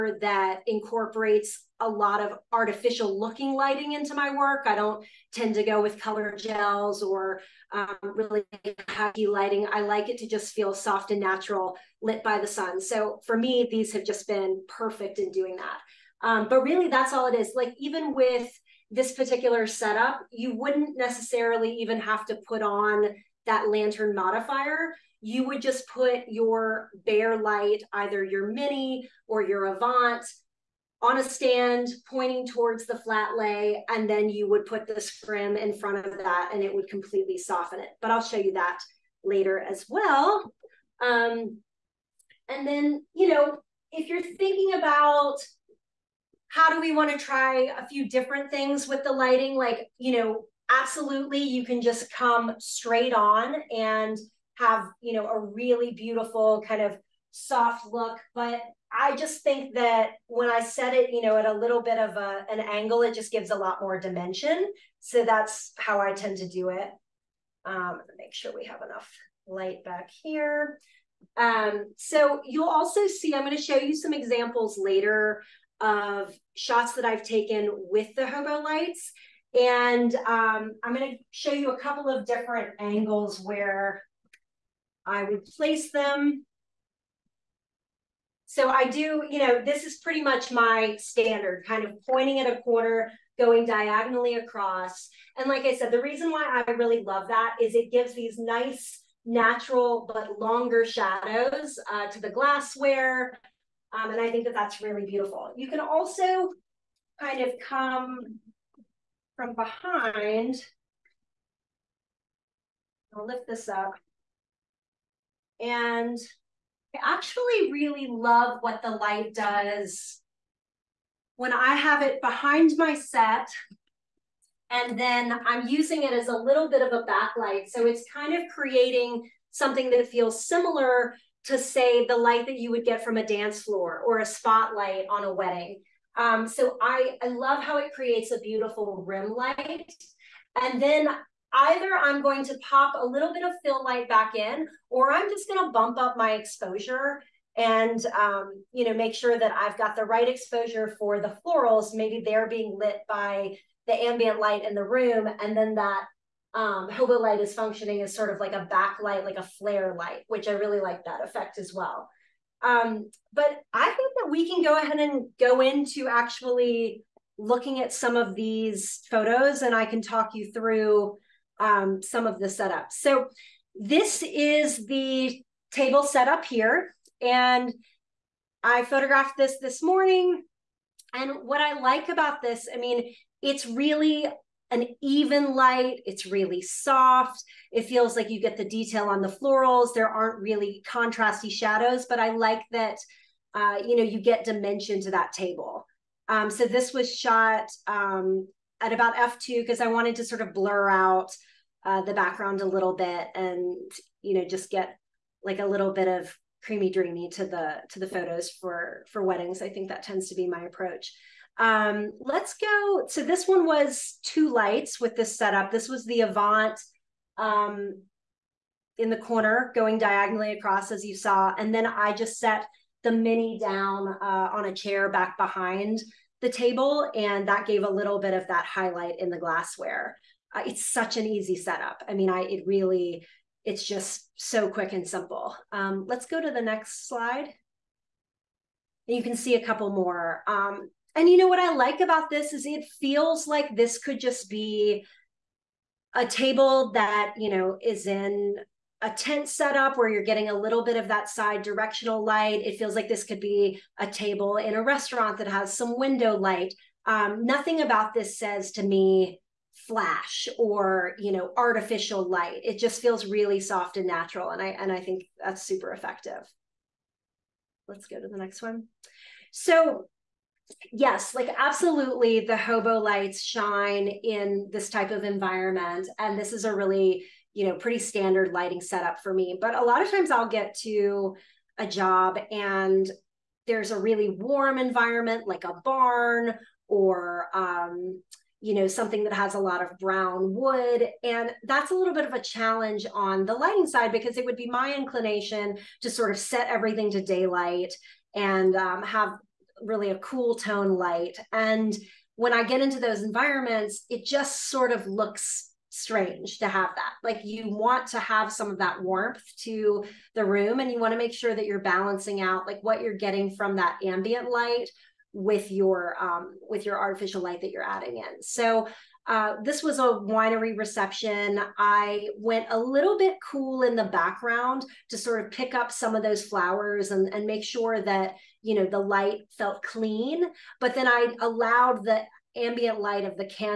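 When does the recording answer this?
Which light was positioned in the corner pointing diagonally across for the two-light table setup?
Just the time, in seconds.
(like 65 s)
216 s.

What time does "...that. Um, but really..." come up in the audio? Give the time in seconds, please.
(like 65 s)
15 s.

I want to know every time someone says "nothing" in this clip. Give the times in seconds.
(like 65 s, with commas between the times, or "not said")
257 s.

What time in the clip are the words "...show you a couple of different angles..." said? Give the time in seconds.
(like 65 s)
81 s.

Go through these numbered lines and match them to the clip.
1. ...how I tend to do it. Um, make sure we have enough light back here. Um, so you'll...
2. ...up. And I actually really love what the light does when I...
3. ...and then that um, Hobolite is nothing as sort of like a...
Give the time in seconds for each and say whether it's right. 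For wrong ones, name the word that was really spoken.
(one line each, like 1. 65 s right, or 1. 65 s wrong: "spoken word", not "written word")
1. 65 s right
2. 113 s right
3. 155 s wrong: "functioning", not "nothing".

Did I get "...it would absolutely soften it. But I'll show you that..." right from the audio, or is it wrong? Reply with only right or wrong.
wrong.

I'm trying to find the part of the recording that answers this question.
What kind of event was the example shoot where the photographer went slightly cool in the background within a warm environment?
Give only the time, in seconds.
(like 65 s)
320 s.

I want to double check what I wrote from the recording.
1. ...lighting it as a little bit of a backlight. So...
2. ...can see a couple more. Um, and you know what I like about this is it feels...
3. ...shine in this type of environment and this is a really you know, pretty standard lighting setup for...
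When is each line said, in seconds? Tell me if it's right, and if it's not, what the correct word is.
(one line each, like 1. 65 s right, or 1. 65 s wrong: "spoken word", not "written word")
1. 125 s wrong: "using", not "lighting"
2. 239 s right
3. 273 s right.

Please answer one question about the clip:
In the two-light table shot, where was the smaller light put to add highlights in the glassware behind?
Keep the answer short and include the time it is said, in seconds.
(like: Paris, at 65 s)
on a chair, at 224 s.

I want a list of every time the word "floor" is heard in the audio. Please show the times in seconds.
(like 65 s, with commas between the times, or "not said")
133 s.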